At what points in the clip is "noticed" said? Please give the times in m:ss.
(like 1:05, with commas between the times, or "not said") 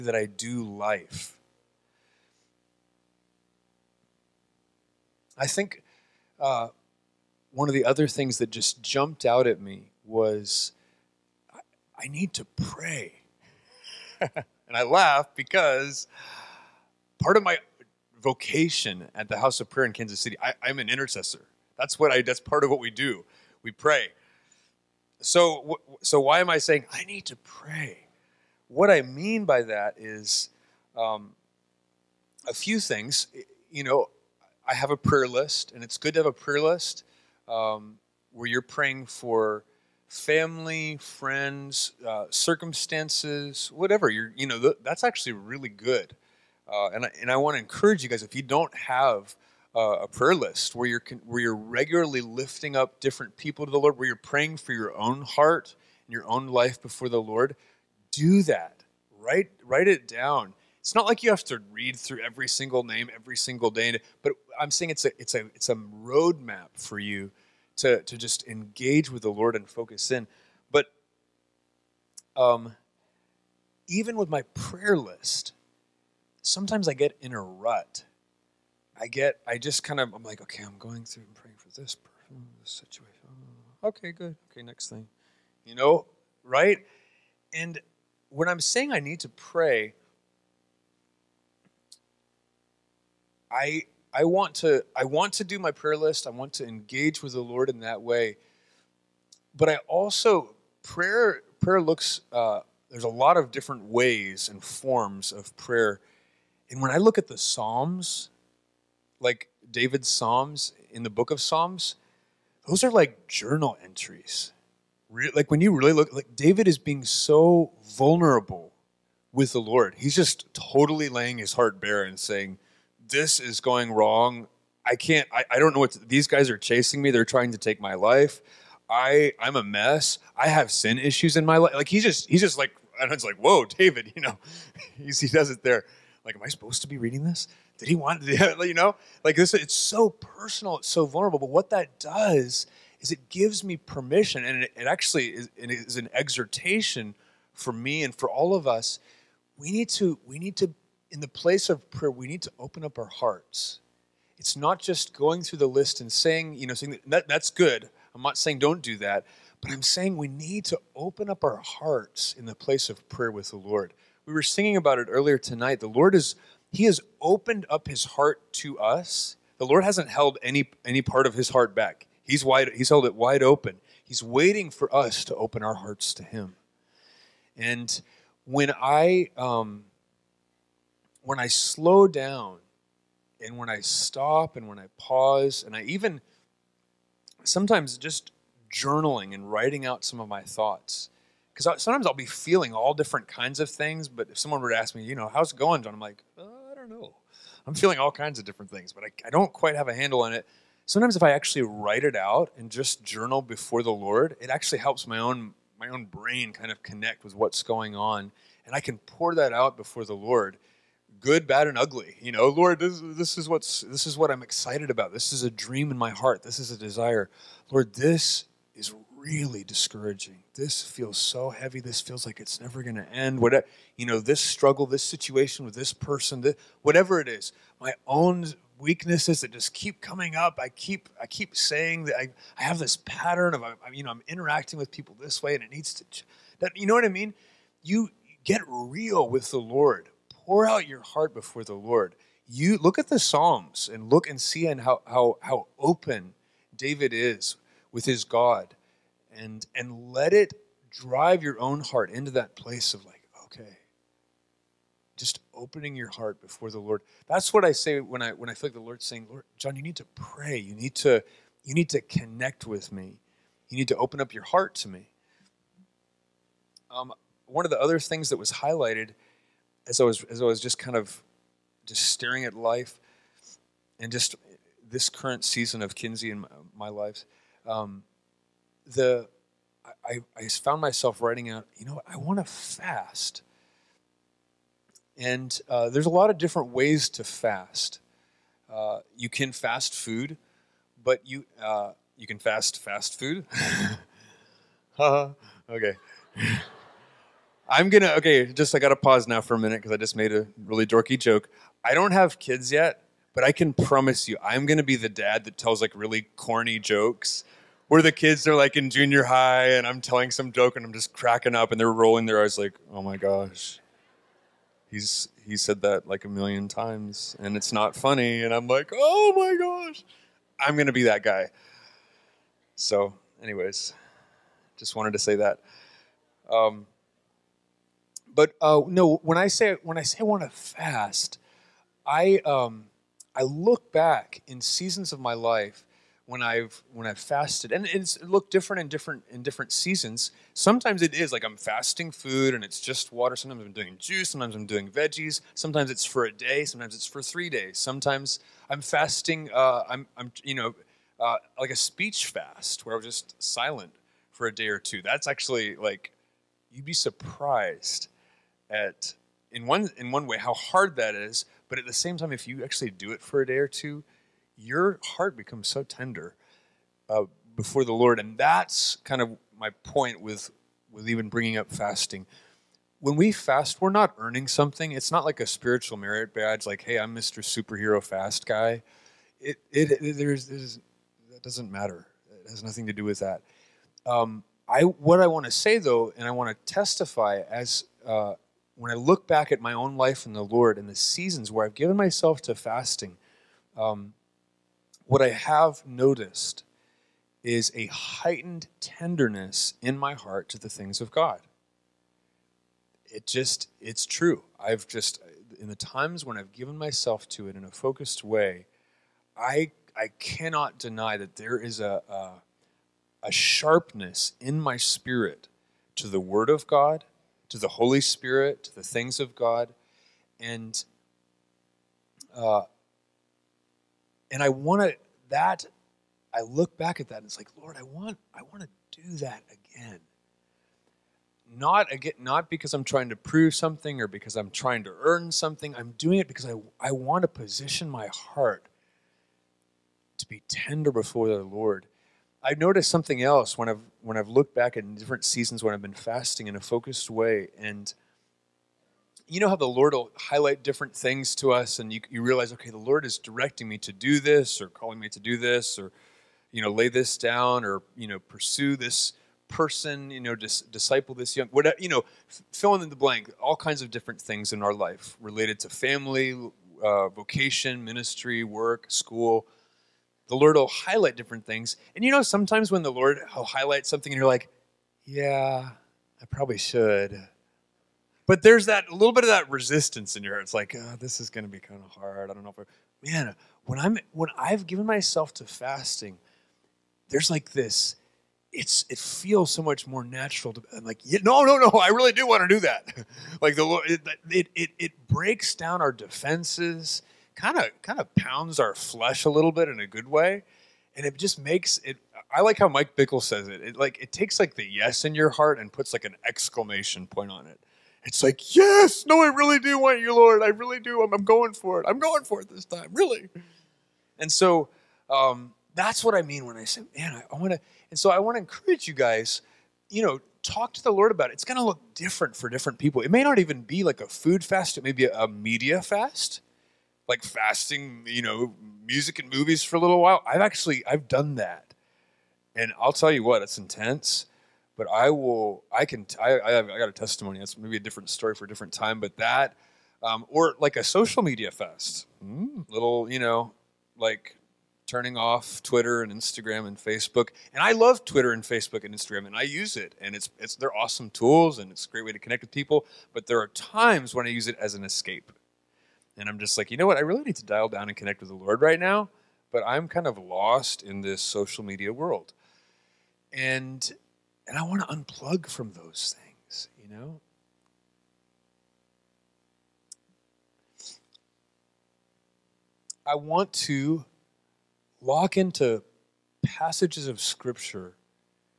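6:35, 7:22.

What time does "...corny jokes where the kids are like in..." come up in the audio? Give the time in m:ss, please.
5:06.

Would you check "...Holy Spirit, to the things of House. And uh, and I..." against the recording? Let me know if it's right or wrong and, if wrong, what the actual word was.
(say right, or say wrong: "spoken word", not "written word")
wrong: "God", not "House".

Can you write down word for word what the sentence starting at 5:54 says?
That's actually like you'd be surprised at in one in one way how hard that is.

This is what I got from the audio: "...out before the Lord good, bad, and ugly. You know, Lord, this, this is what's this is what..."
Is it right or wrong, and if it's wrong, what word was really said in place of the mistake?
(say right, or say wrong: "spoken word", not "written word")
right.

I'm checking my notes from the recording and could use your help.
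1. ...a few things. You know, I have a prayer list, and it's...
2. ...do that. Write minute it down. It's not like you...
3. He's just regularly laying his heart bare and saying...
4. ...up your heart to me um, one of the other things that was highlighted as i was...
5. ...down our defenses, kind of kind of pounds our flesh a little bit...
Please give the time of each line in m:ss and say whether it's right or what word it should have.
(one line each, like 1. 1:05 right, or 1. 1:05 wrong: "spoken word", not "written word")
1. 0:32 right
2. 0:58 wrong: "write", not "minute"
3. 1:59 wrong: "totally", not "regularly"
4. 4:24 right
5. 8:15 right.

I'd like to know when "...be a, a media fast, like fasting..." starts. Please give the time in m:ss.
8:44.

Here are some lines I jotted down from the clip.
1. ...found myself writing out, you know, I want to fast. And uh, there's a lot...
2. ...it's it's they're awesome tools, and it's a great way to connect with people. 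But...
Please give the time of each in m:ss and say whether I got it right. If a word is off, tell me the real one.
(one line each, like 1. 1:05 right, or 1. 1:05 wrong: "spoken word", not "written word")
1. 4:40 right
2. 9:10 right.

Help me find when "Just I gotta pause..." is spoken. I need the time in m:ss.
4:58.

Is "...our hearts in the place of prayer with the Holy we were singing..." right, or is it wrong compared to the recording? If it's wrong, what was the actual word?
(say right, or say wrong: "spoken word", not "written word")
wrong: "Lord", not "Holy".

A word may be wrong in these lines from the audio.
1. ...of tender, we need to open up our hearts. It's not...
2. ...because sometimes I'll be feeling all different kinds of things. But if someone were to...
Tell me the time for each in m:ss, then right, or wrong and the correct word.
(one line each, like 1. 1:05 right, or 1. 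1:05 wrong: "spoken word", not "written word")
1. 2:31 wrong: "prayer", not "tender"
2. 3:11 right.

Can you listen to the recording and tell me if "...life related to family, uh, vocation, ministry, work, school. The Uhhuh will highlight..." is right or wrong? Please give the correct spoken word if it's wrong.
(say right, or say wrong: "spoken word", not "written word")
wrong: "Lord", not "Uhhuh".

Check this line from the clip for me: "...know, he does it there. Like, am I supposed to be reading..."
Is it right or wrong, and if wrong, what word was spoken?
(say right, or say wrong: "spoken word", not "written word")
right.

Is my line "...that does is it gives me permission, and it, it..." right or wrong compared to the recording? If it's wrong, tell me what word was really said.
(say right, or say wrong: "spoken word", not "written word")
right.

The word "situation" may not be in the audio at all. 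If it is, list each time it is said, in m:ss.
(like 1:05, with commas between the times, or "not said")
1:22, 3:45.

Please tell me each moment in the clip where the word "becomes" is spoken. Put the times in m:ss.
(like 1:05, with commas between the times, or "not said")
6:05.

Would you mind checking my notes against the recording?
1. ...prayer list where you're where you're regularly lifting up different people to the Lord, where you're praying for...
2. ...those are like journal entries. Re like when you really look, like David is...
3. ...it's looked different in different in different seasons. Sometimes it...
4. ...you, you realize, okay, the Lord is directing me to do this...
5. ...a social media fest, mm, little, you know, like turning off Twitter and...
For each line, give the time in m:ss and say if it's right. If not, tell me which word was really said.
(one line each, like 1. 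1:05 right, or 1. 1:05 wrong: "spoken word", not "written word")
1. 0:50 right
2. 1:52 right
3. 5:37 right
4. 7:31 right
5. 9:00 right.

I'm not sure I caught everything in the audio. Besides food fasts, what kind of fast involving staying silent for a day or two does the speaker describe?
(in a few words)
speech fast.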